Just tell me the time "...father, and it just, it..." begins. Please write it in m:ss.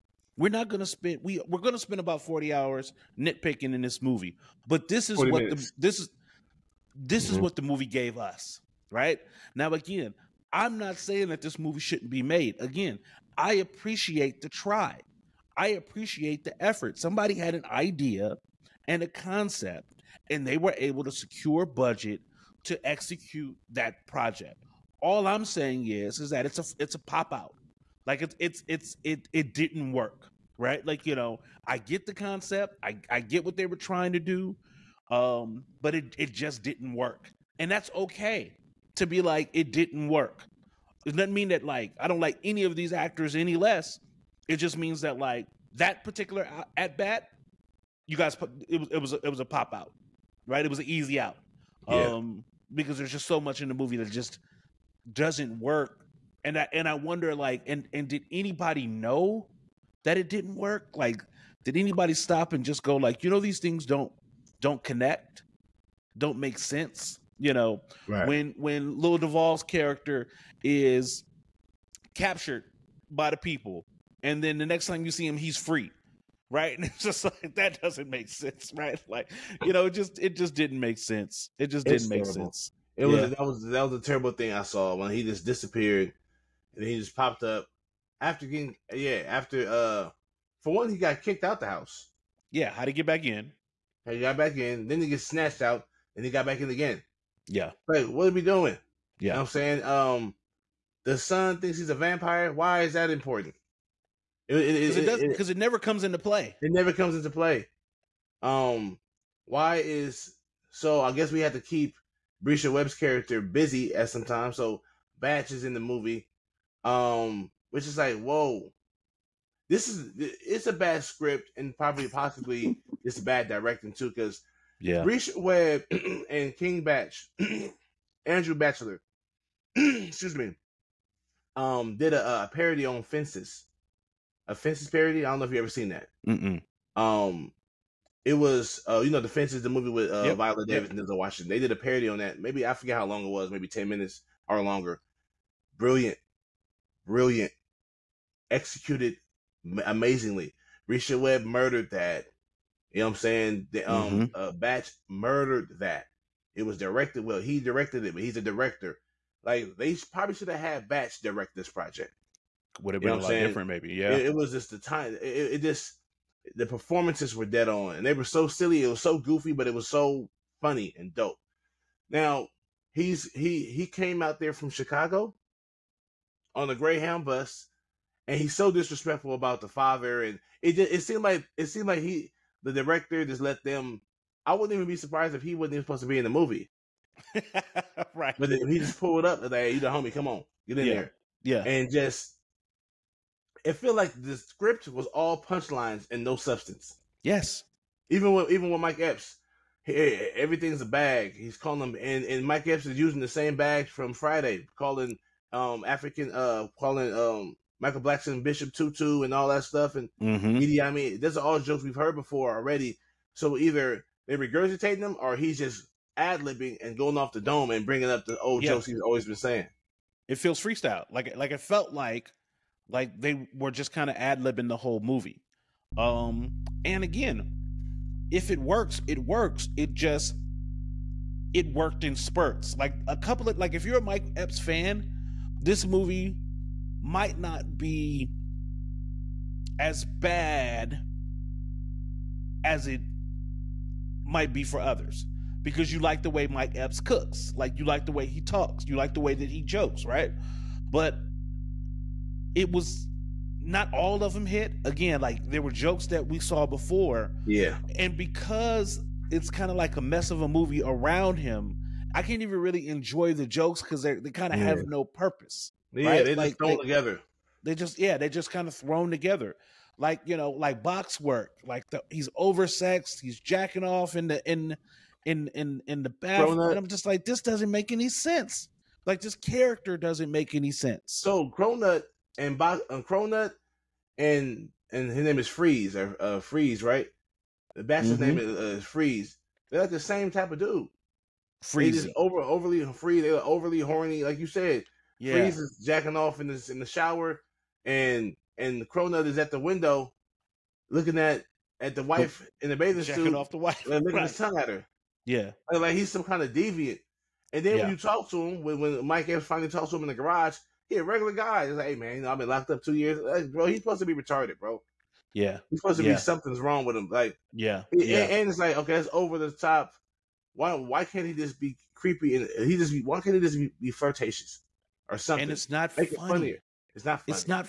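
2:59.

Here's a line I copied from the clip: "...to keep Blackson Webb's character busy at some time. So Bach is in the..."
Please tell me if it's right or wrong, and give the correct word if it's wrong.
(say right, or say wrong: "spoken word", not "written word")
wrong: "Bresha", not "Blackson".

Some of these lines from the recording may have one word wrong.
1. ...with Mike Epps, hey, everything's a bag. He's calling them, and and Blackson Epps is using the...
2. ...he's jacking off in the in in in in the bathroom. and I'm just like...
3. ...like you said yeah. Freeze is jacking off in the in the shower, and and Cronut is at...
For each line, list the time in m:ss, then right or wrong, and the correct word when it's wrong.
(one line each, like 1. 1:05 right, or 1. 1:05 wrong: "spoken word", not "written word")
1. 3:18 wrong: "Mike", not "Blackson"
2. 4:33 right
3. 4:54 right.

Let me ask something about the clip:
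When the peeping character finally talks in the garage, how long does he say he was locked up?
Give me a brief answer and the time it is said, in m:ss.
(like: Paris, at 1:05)
2 years, at 5:12.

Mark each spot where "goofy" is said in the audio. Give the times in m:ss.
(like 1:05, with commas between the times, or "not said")
2:49.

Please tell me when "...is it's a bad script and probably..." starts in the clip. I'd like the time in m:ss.
1:59.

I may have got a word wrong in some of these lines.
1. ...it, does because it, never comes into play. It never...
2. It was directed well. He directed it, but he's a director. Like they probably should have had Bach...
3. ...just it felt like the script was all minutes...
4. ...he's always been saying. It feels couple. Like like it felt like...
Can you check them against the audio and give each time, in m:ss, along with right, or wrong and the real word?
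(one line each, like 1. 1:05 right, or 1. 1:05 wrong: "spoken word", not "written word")
1. 1:44 right
2. 2:36 right
3. 3:11 wrong: "punchlines", not "minutes"
4. 3:38 wrong: "freestyle", not "couple".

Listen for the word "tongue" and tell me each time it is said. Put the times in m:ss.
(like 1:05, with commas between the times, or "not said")
5:04.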